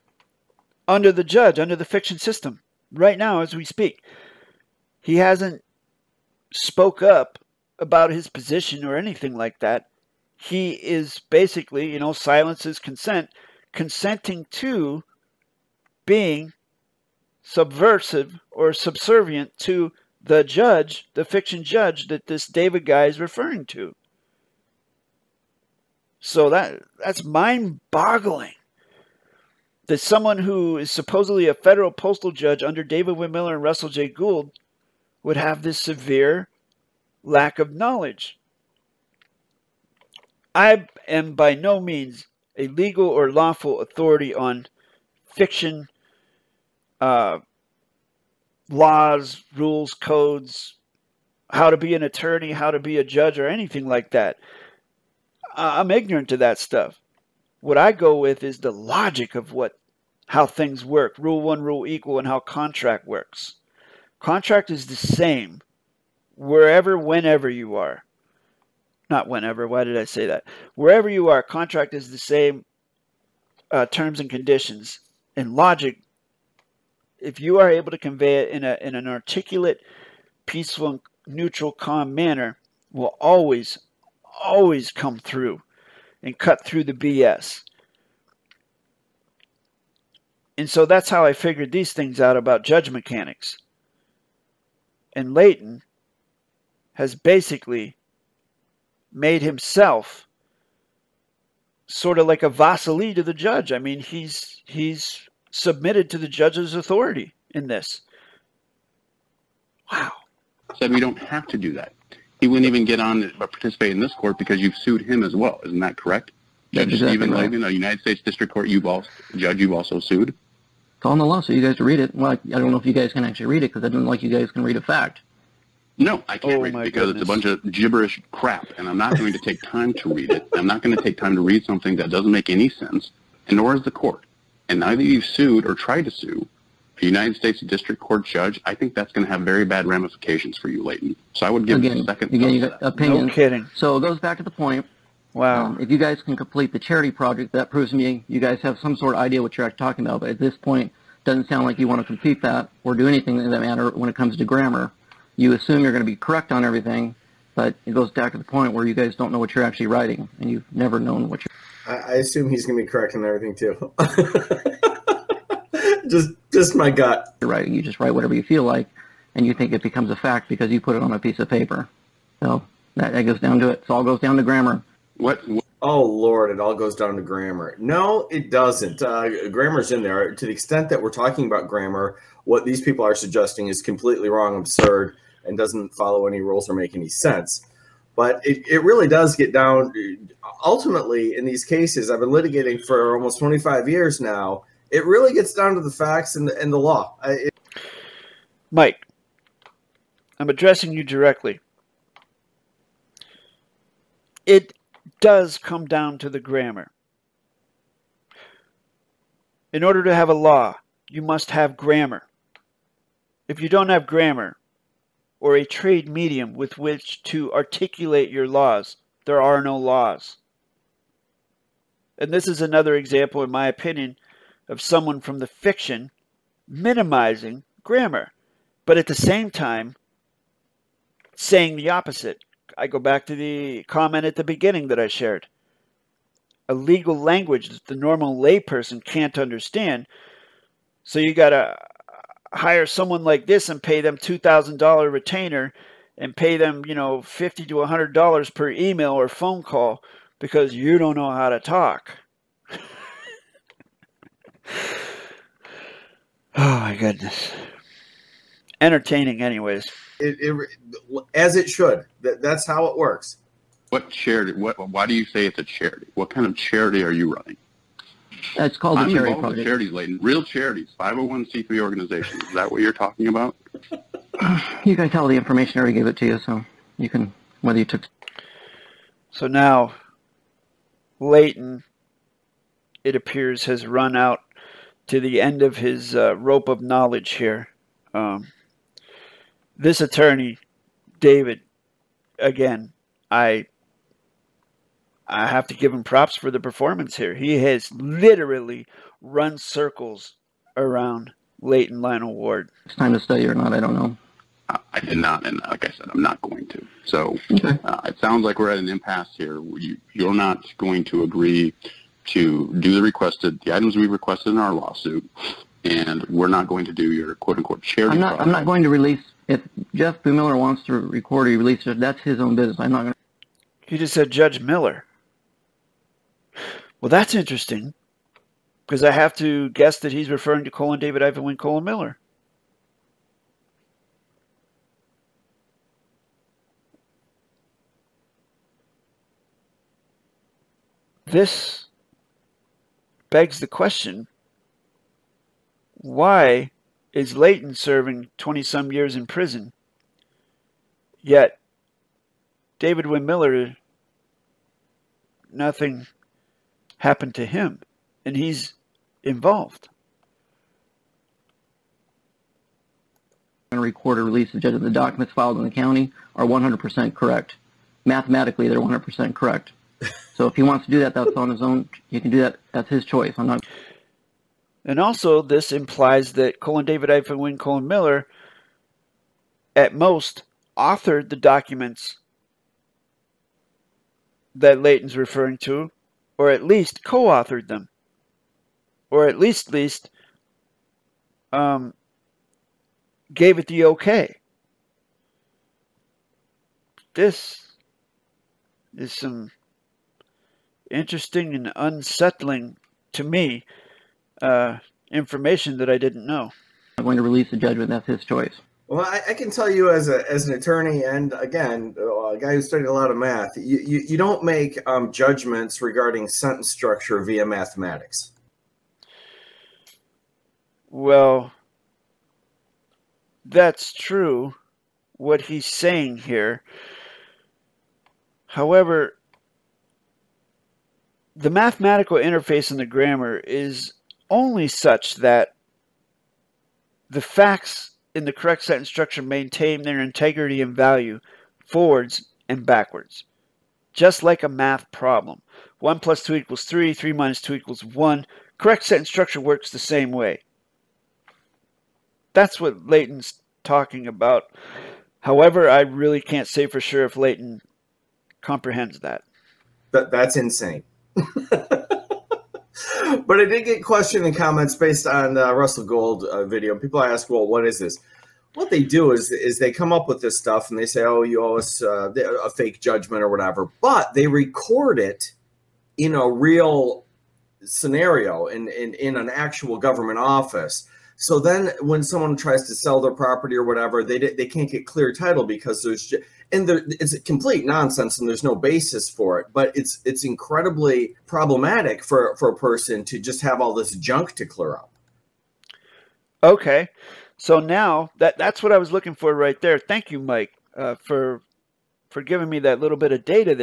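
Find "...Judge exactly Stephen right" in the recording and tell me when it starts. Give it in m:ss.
1:56.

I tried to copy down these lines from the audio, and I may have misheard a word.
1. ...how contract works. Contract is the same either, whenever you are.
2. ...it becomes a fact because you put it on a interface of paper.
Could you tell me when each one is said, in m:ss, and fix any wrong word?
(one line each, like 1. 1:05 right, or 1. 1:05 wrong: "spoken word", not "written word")
1. 1:02 wrong: "wherever", not "either"
2. 2:49 wrong: "piece", not "interface".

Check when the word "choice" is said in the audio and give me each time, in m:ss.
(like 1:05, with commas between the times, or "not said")
6:13, 6:48.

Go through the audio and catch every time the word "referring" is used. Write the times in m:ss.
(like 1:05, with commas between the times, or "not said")
0:23, 5:30, 6:25.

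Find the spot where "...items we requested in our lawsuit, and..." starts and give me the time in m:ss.
5:13.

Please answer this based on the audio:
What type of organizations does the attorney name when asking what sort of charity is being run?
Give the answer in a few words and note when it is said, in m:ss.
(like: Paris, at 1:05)
501c3 organizations, at 4:30.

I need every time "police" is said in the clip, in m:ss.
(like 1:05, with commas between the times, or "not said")
not said.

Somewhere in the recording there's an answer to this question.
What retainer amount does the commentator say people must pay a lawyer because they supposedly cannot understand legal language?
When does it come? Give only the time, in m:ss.
4:04.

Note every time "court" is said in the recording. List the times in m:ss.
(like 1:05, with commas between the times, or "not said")
1:54, 1:58, 2:13, 2:17.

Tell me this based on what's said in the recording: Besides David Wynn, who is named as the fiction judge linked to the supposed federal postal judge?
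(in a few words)
Russell J. Gould.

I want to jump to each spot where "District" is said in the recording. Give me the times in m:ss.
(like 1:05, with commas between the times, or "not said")
1:58, 2:17.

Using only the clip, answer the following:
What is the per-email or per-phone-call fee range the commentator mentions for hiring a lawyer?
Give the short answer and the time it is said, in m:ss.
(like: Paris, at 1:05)
$50 to $100, at 4:07.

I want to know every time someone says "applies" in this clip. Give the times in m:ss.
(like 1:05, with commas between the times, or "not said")
not said.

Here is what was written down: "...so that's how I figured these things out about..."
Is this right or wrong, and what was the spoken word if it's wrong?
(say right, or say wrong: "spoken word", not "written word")
right.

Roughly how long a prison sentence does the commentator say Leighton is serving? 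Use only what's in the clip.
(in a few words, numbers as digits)
20 some years.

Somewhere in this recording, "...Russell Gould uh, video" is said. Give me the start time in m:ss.
7:45.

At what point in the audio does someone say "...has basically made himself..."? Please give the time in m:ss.
1:36.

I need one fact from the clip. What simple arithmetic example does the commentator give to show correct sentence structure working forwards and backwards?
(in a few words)
1 plus 2 equals 3.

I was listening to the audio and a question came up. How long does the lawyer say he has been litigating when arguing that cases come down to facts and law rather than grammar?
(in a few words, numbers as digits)
almost 25 years.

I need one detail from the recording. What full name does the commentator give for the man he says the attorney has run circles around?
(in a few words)
Leighton Lionel Ward.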